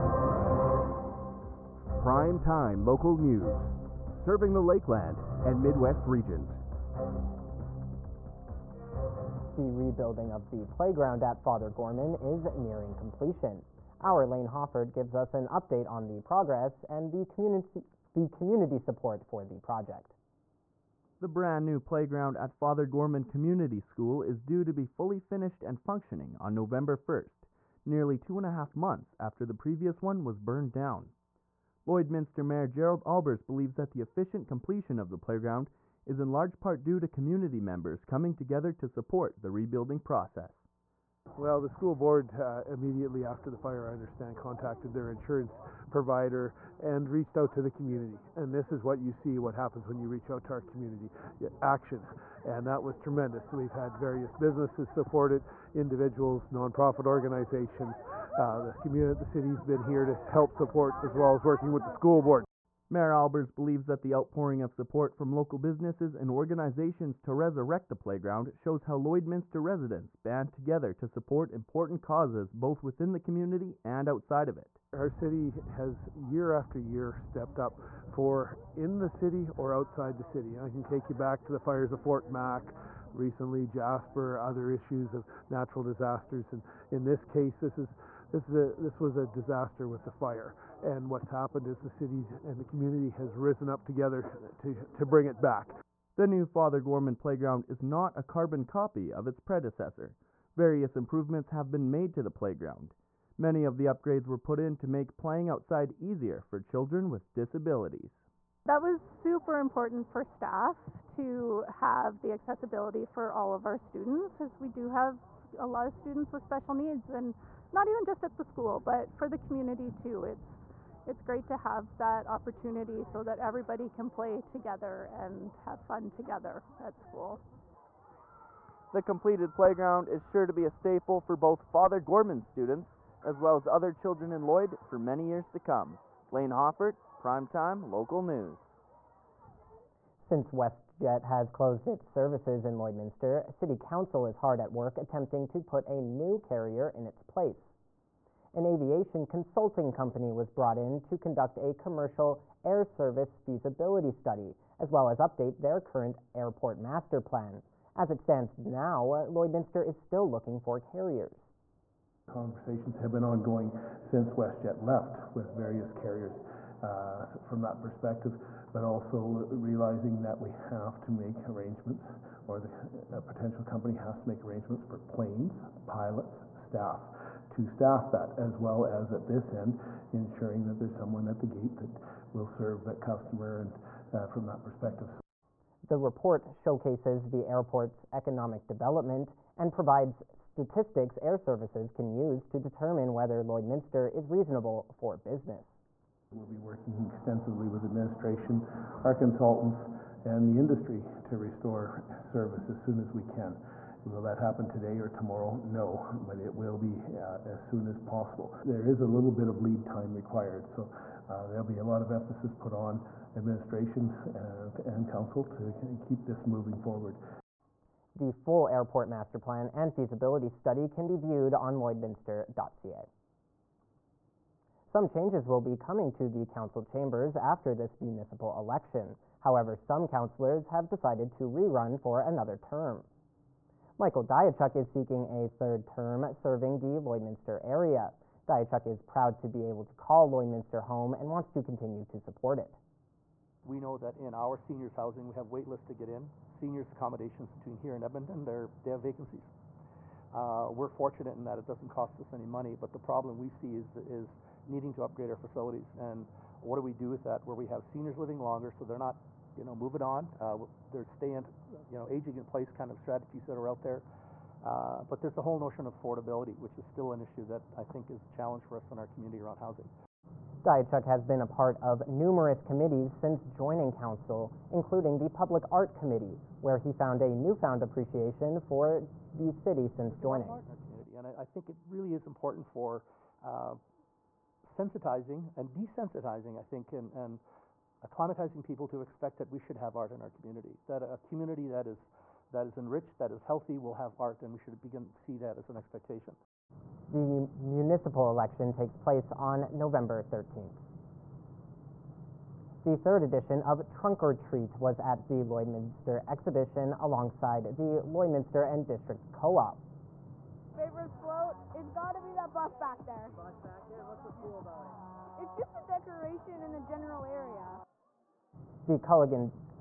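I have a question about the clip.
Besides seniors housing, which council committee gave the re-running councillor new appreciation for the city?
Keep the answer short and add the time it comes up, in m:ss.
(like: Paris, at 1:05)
Public Art Committee, at 4:35.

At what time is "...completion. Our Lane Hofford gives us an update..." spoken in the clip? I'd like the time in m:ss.
0:12.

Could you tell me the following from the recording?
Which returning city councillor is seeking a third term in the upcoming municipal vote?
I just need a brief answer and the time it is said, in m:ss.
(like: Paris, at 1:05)
Michael Diachuk, at 3:53.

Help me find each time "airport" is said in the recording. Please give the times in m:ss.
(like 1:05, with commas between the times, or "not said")
2:36, 3:07, 3:38.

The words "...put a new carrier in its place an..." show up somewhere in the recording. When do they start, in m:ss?
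2:25.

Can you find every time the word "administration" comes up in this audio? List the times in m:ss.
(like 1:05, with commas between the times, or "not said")
3:17, 3:33.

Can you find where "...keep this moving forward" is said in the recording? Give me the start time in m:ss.
3:35.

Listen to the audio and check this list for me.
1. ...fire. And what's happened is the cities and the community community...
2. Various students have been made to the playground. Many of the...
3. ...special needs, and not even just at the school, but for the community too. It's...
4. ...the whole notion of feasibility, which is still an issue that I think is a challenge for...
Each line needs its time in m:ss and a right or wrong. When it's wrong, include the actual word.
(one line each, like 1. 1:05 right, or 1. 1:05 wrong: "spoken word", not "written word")
1. 1:30 right
2. 1:40 wrong: "improvements", not "students"
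3. 1:56 right
4. 4:25 wrong: "affordability", not "feasibility".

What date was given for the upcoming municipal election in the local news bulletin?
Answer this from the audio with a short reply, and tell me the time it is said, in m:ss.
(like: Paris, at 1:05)
November 13, at 4:59.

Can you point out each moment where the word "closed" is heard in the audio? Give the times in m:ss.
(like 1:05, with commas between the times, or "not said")
2:21.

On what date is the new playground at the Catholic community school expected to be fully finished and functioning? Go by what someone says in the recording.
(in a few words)
November 1.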